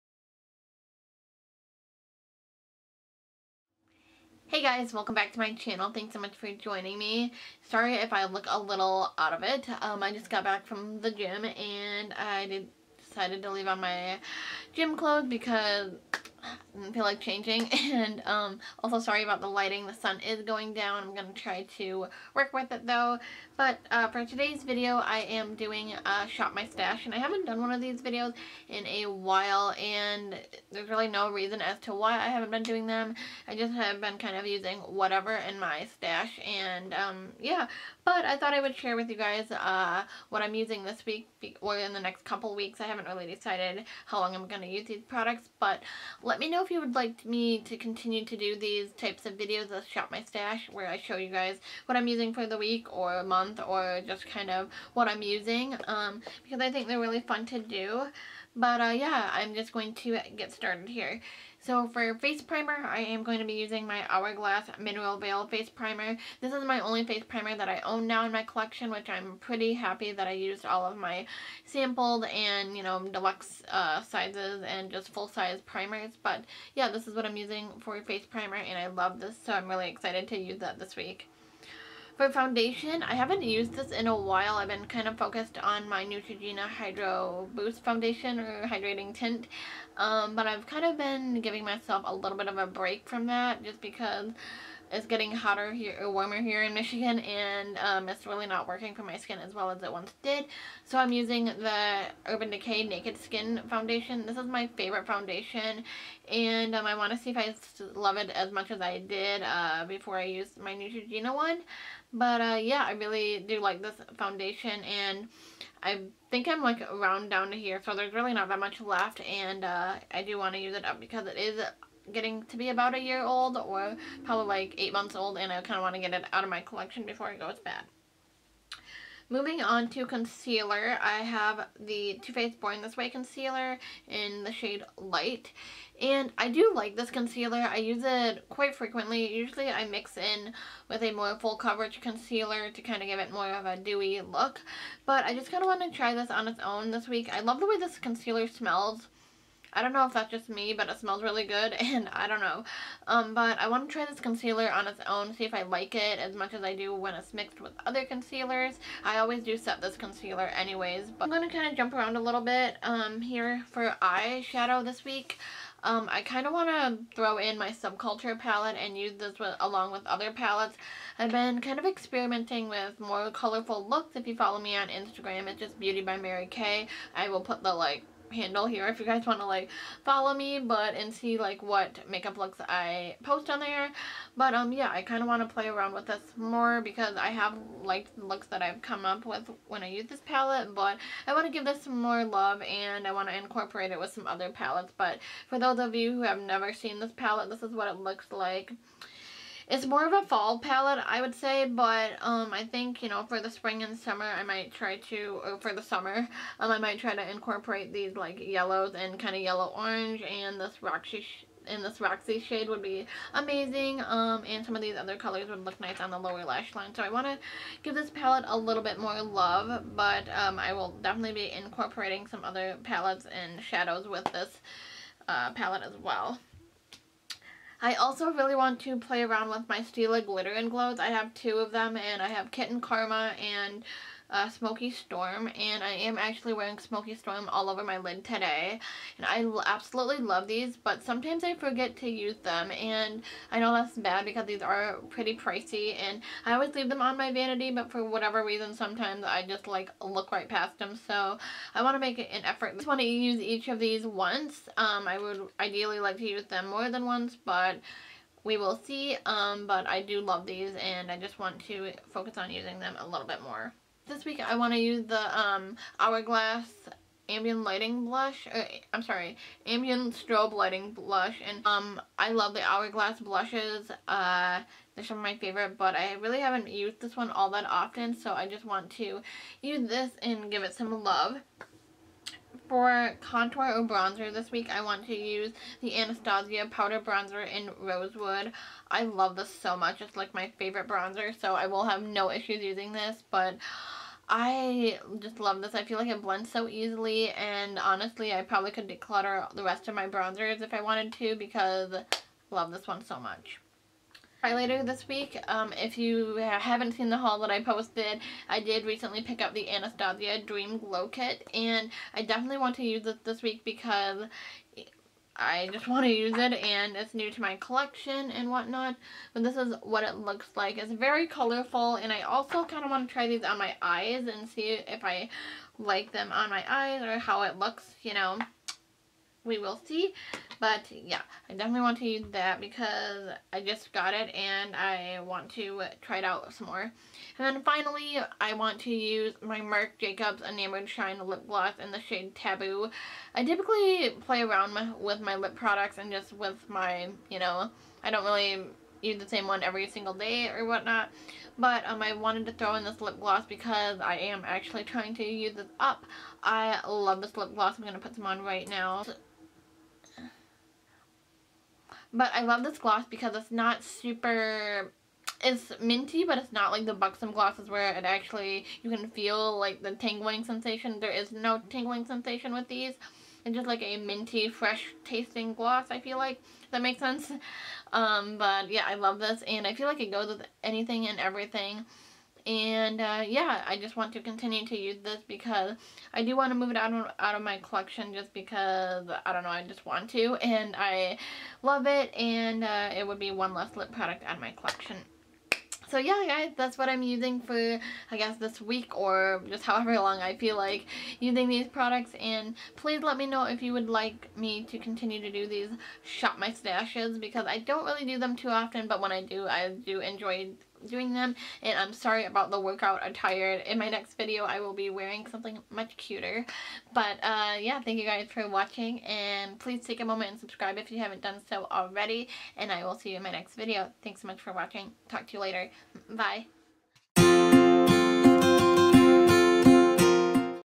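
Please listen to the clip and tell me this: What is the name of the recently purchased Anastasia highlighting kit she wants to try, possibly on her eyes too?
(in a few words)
Dream Glow Kit.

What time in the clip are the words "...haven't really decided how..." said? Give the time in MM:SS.
00:42.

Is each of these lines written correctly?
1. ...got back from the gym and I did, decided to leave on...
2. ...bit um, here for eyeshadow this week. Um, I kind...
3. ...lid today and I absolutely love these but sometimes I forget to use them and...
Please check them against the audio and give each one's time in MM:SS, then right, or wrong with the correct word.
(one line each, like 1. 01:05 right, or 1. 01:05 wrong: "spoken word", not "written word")
1. 00:10 right
2. 02:42 right
3. 03:57 right.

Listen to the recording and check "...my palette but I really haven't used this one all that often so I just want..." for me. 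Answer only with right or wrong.
wrong.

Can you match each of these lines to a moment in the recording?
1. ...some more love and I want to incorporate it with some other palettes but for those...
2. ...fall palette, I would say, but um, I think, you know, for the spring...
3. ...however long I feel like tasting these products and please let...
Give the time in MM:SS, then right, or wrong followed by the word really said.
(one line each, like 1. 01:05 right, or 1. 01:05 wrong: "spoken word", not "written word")
1. 03:11 right
2. 03:20 right
3. 06:39 wrong: "using", not "tasting".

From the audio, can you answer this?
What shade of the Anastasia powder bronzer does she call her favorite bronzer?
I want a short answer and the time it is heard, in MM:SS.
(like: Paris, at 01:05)
Rosewood, at 04:47.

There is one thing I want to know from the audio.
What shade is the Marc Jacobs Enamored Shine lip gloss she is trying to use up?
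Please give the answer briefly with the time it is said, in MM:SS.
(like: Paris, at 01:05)
Taboo, at 05:42.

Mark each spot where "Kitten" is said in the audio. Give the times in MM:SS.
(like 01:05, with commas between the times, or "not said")
03:52.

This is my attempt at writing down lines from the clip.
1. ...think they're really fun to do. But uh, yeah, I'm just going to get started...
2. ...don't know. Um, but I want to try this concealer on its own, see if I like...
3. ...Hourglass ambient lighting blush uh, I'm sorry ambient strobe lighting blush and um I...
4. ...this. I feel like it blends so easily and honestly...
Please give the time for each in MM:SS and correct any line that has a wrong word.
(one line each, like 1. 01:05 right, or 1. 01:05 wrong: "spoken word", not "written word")
1. 00:56 right
2. 02:32 right
3. 04:25 right
4. 04:55 right.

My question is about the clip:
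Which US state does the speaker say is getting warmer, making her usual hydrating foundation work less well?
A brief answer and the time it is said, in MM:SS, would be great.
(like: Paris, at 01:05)
Michigan, at 01:36.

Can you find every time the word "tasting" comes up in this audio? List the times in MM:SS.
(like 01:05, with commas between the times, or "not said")
06:15.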